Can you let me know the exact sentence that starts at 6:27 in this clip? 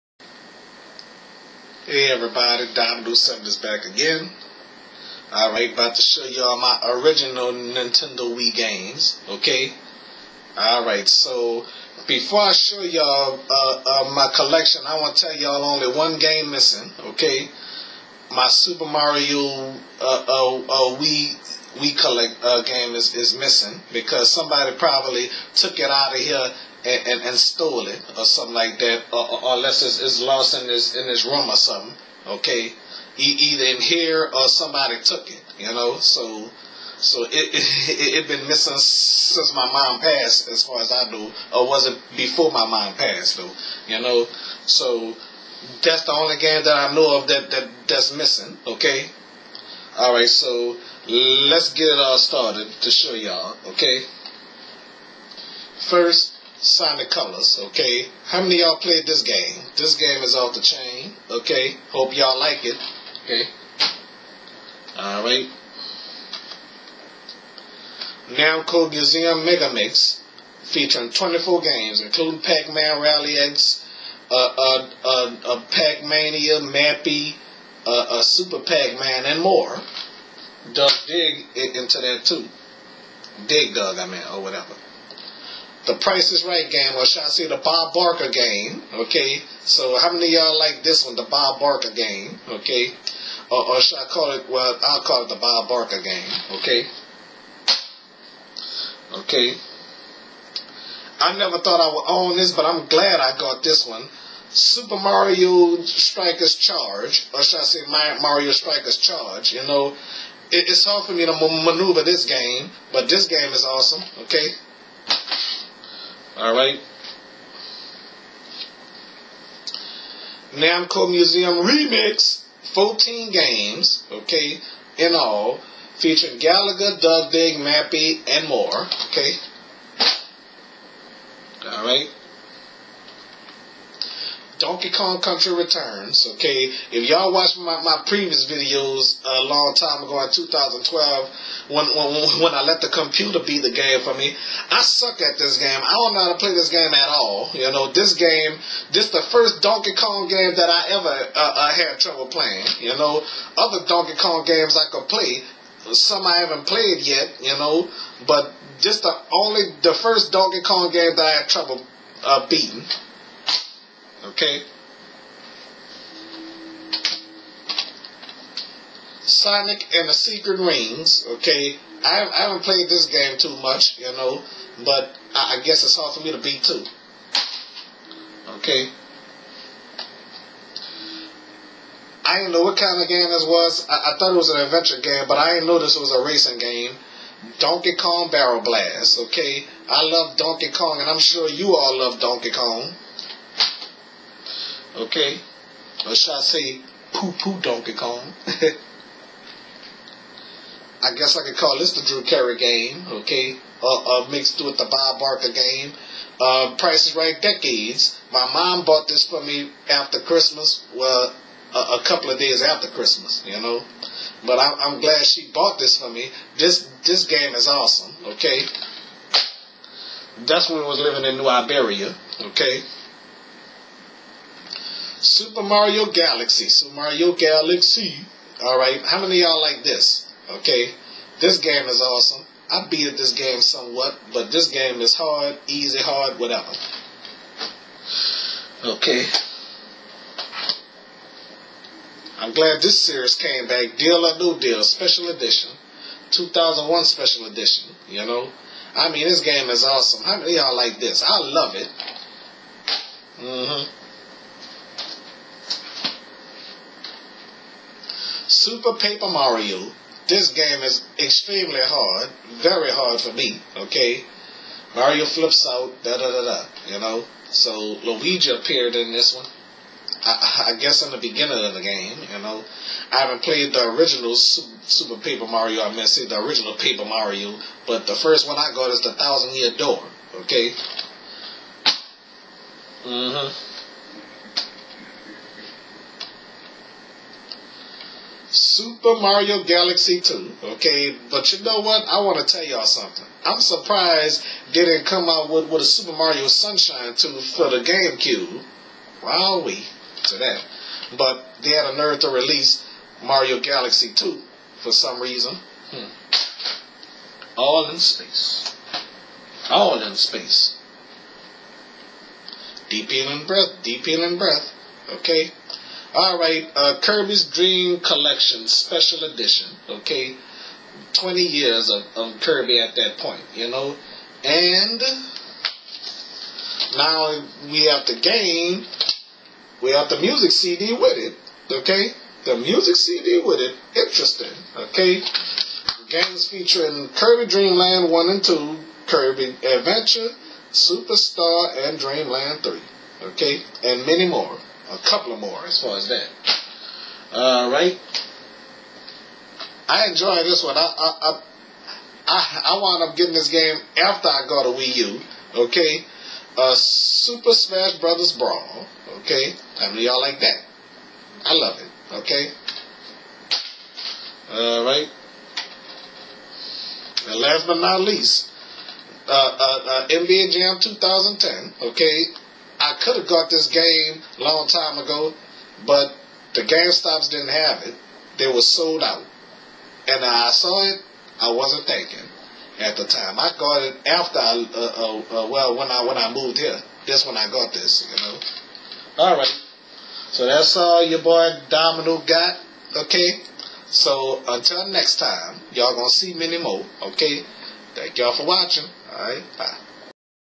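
That's when I got this, you know.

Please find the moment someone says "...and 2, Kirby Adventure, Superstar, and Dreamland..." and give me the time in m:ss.
5:38.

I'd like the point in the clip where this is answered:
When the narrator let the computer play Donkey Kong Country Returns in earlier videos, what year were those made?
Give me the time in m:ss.
2:20.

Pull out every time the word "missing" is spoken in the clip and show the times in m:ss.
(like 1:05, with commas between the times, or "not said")
0:16, 0:23, 0:38, 0:48.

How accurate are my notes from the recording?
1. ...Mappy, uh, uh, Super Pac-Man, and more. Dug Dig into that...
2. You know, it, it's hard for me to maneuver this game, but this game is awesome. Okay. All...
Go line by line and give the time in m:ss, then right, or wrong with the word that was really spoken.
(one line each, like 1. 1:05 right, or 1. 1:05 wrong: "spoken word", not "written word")
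1. 1:16 right
2. 1:49 right.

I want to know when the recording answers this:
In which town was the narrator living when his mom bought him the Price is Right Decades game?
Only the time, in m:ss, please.
3:41.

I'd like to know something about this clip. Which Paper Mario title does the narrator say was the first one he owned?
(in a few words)
Thousand Year Door.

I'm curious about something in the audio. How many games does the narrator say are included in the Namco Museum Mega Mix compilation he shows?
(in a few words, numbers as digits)
24.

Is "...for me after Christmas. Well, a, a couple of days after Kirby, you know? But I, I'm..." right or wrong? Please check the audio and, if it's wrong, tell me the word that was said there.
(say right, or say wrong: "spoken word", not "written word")
wrong: "Christmas", not "Kirby".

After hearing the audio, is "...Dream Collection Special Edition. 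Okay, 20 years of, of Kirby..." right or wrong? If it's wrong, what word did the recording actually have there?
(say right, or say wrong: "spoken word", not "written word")
right.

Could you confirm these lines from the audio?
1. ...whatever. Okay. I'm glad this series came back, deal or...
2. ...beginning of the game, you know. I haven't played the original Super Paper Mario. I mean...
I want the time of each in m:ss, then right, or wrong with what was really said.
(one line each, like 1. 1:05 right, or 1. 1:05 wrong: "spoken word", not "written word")
1. 3:56 right
2. 4:31 right.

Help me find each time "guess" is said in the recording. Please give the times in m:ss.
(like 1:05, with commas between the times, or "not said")
2:55, 3:21, 4:30.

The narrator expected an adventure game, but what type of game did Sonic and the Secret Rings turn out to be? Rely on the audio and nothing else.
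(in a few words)
racing game.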